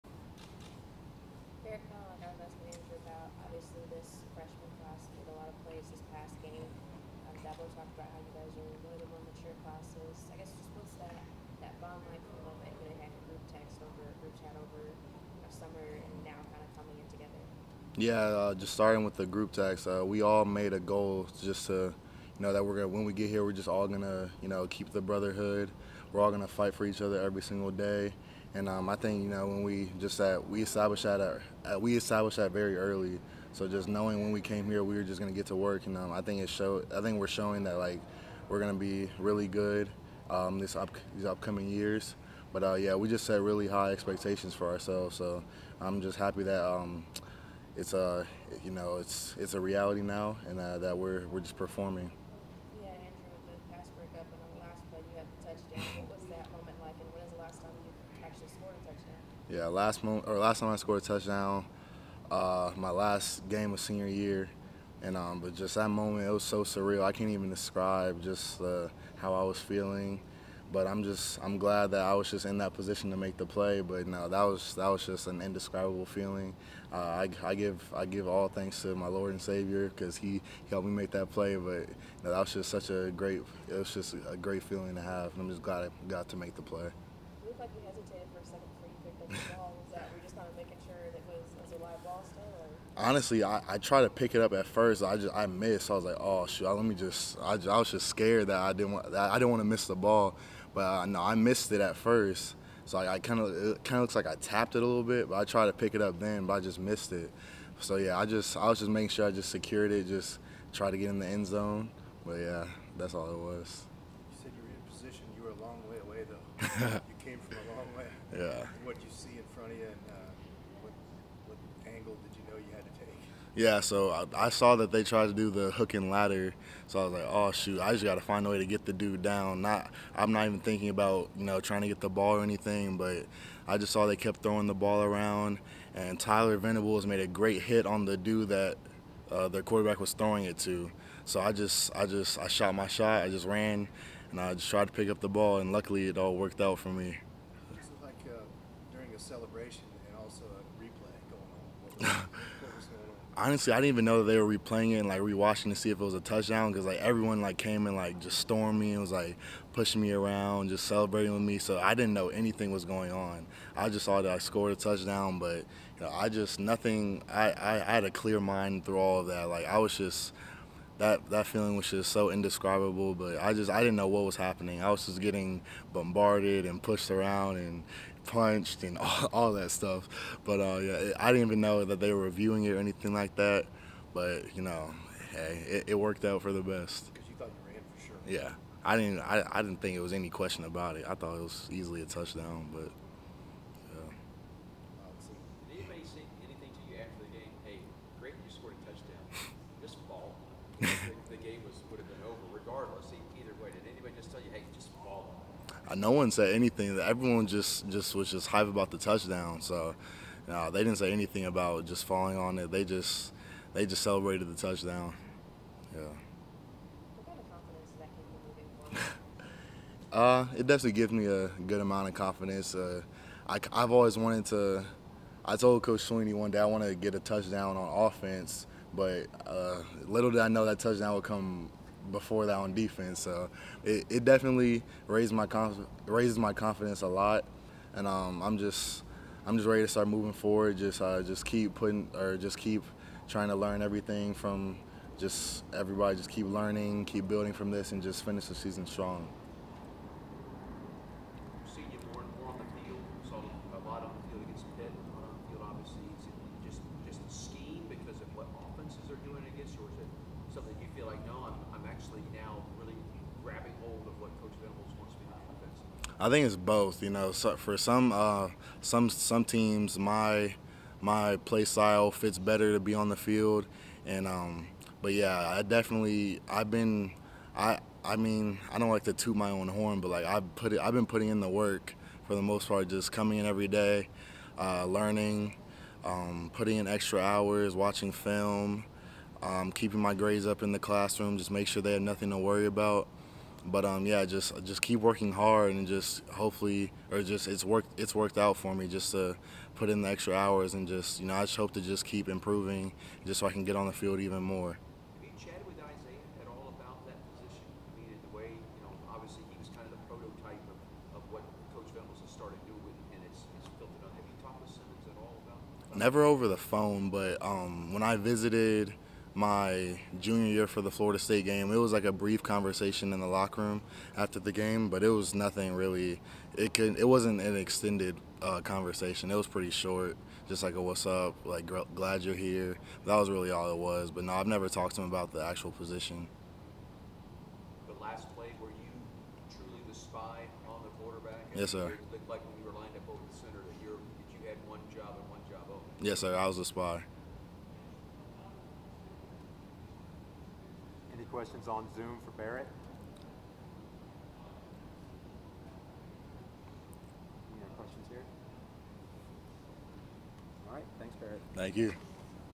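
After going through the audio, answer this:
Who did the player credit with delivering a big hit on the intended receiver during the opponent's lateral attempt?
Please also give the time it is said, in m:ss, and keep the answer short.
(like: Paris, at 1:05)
Tyler Venables, at 2:16.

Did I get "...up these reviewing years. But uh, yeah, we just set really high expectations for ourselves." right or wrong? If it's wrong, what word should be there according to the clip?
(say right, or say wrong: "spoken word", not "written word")
wrong: "upcoming", not "reviewing".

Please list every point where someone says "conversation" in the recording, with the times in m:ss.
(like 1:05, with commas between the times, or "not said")
5:22, 5:28.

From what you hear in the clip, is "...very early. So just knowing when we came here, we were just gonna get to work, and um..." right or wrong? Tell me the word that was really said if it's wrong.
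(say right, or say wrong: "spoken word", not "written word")
right.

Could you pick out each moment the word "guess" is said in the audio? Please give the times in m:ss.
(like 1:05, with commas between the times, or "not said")
0:10.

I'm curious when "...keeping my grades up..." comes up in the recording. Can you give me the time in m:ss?
4:49.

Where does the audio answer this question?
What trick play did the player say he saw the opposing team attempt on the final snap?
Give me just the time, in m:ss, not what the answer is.
2:05.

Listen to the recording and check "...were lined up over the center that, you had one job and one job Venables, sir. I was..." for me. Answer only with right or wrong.
wrong.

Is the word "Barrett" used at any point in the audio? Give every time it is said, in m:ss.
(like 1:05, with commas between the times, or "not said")
5:52, 6:01.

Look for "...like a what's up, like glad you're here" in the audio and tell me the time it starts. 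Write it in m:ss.
5:30.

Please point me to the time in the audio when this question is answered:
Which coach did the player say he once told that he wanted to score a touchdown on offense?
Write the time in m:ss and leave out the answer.
3:45.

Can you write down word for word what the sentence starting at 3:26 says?
Everyone just just was just hype about the touchdown.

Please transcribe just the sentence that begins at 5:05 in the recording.
Have with Isaiah at all about that position?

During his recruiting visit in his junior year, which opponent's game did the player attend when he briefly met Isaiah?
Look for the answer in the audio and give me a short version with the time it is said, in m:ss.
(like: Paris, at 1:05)
Florida State, at 5:20.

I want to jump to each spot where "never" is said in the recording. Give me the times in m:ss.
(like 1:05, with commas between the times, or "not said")
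5:15, 5:34.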